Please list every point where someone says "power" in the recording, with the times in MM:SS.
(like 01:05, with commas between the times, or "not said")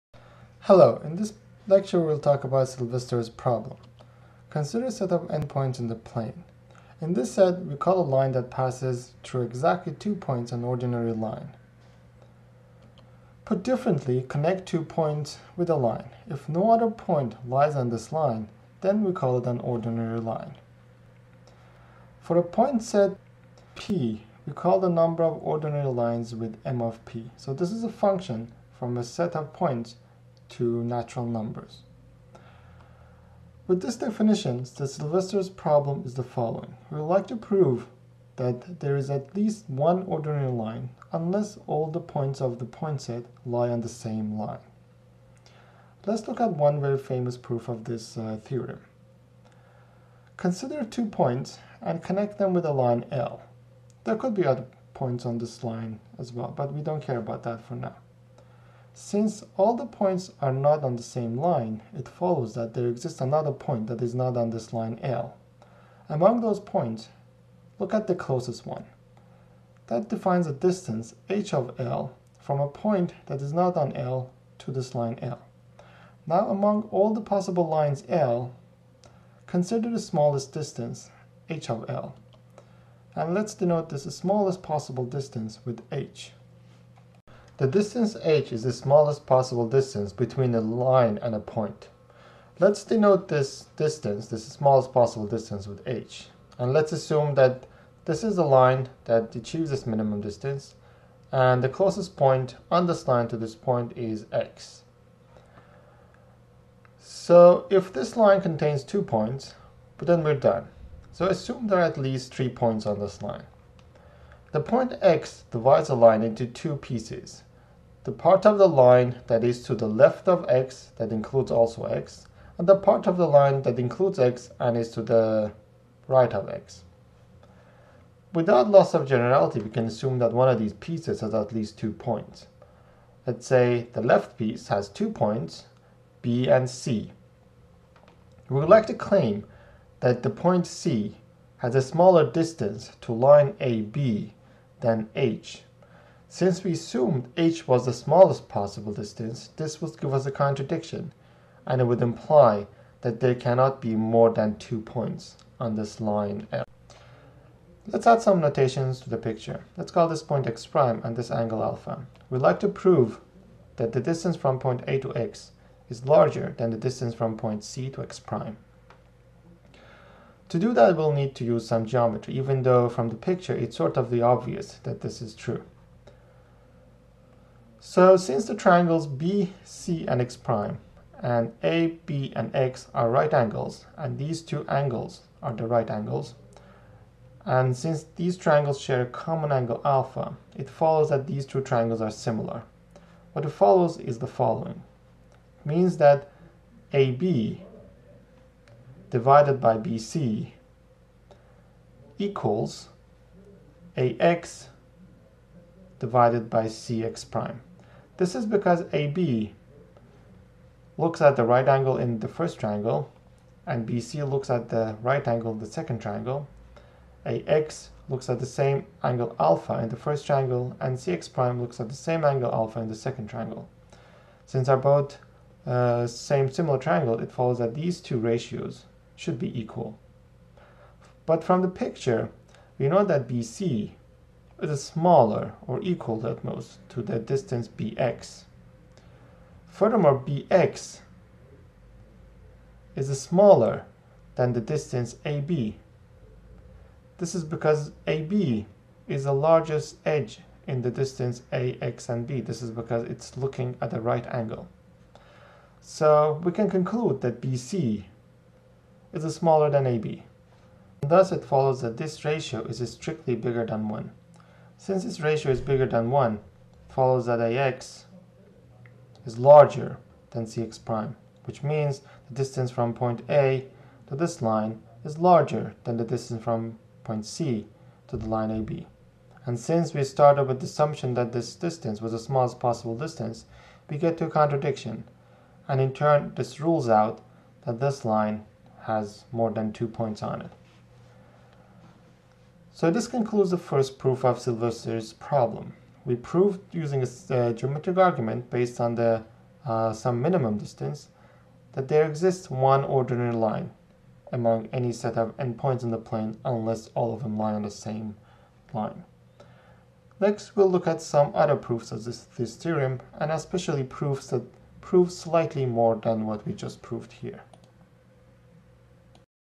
not said.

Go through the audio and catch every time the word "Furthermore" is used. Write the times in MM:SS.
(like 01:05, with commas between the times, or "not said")
03:59.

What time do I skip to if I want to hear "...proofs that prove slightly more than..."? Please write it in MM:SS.
05:13.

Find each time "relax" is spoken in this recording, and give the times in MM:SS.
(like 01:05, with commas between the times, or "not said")
not said.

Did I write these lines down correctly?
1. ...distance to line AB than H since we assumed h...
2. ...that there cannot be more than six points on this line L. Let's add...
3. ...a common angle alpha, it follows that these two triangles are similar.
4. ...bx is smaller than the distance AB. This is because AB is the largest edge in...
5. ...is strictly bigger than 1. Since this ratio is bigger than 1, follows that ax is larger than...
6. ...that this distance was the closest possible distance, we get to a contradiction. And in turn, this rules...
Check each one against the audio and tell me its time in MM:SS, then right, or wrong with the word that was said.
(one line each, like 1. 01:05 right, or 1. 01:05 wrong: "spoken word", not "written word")
1. 02:22 right
2. 02:33 wrong: "two", not "six"
3. 03:09 right
4. 04:00 right
5. 04:22 right
6. 04:41 wrong: "smallest", not "closest".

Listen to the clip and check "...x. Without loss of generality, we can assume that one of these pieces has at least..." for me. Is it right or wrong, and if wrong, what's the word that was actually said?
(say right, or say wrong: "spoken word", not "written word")
right.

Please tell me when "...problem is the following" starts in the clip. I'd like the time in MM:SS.
00:35.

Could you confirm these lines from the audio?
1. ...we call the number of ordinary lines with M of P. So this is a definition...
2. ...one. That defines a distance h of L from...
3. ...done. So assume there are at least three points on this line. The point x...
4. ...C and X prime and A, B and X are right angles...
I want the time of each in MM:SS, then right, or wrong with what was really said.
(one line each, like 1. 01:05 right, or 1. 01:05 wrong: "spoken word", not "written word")
1. 00:24 wrong: "function", not "definition"
2. 01:08 right
3. 01:50 right
4. 02:59 right.